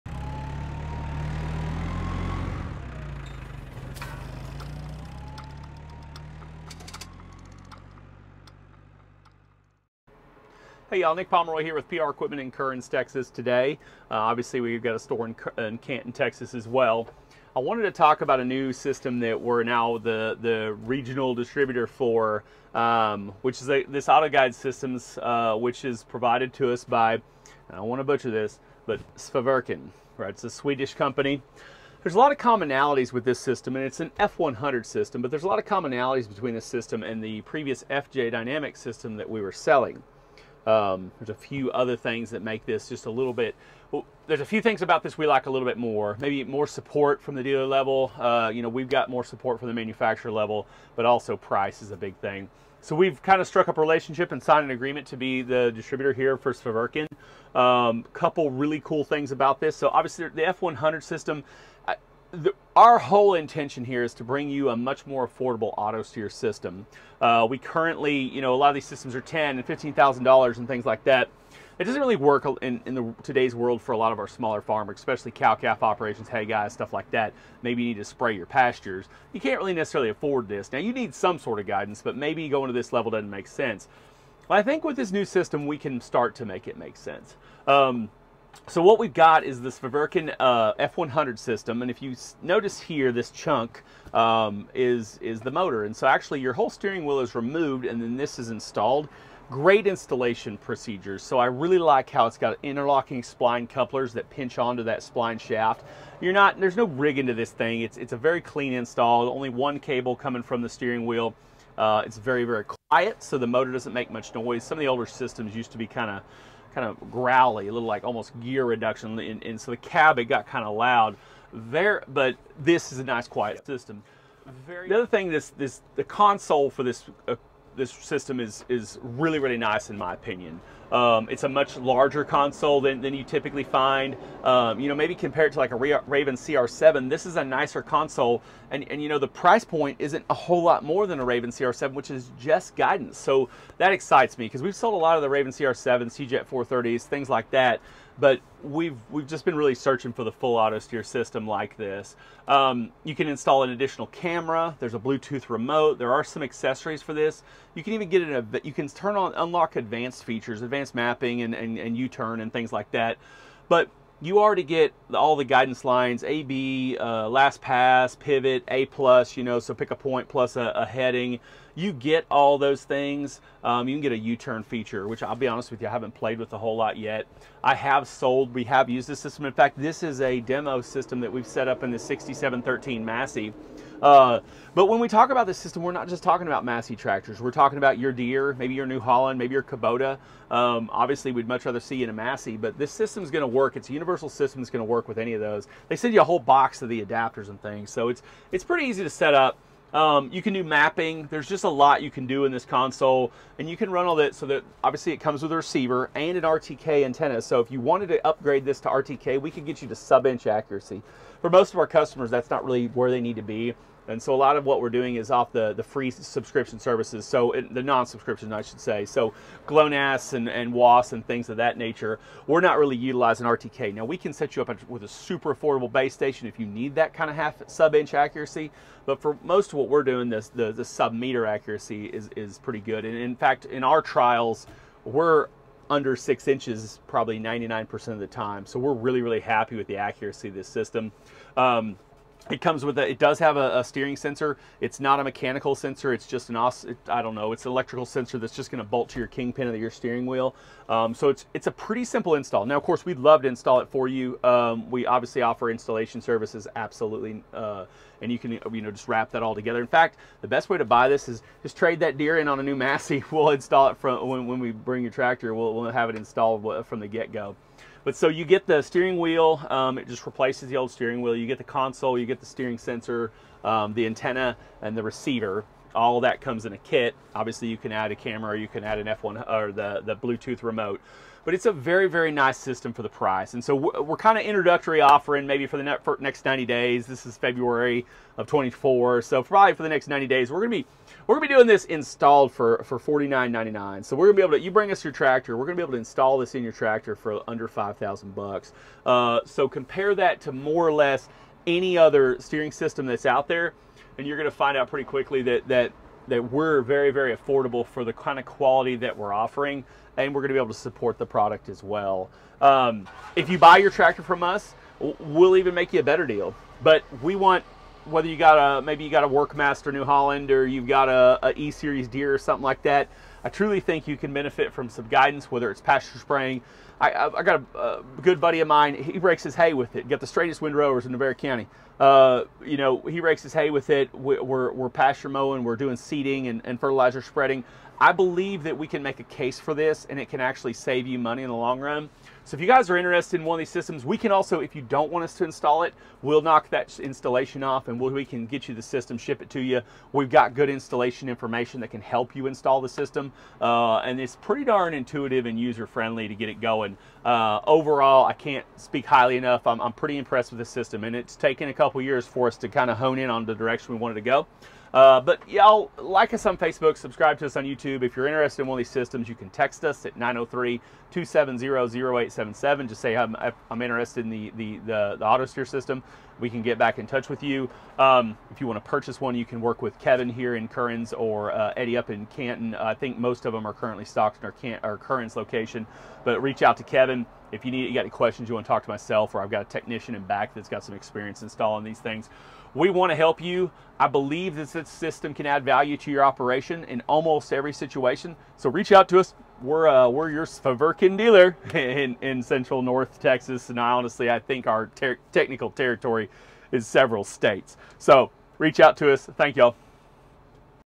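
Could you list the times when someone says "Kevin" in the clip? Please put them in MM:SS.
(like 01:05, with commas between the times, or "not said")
06:19, 06:26.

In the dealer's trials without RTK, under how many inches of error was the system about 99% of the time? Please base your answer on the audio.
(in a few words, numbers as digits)
6 inches.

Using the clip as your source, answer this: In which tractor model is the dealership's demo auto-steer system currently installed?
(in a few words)
6713 Massey.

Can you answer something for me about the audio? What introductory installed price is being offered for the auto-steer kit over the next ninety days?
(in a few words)
$4,999.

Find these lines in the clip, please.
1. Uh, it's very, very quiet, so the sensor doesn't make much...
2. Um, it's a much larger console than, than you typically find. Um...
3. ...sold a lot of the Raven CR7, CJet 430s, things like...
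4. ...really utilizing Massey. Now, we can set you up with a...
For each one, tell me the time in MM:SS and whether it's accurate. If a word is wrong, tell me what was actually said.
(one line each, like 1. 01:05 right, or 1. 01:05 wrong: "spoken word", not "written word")
1. 01:51 wrong: "motor", not "sensor"
2. 02:10 right
3. 02:24 right
4. 03:42 wrong: "RTK", not "Massey".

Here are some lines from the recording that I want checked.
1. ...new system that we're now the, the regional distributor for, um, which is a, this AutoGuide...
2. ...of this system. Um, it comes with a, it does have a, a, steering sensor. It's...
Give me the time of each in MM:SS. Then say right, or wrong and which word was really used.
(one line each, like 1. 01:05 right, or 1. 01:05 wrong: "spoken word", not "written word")
1. 00:18 right
2. 04:00 right.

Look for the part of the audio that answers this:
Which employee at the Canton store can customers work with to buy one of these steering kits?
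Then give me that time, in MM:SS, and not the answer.
06:21.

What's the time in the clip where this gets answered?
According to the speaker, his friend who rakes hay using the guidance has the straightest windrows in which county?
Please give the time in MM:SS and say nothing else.
05:31.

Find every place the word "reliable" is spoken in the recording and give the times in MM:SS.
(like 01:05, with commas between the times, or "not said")
not said.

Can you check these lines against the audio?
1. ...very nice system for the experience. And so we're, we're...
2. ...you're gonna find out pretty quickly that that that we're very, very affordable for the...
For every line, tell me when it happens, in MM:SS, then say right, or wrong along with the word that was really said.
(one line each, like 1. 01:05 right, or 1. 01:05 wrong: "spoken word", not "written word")
1. 04:42 wrong: "price", not "experience"
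2. 05:04 right.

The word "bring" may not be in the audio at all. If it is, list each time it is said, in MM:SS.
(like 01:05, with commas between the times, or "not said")
01:04, 04:24, 04:54.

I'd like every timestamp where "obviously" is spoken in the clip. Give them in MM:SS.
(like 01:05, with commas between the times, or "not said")
00:14, 00:59, 03:10, 03:24, 04:15, 04:37.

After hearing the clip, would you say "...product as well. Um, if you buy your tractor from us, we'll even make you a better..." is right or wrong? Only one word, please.
right.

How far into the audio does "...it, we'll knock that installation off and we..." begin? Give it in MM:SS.
05:45.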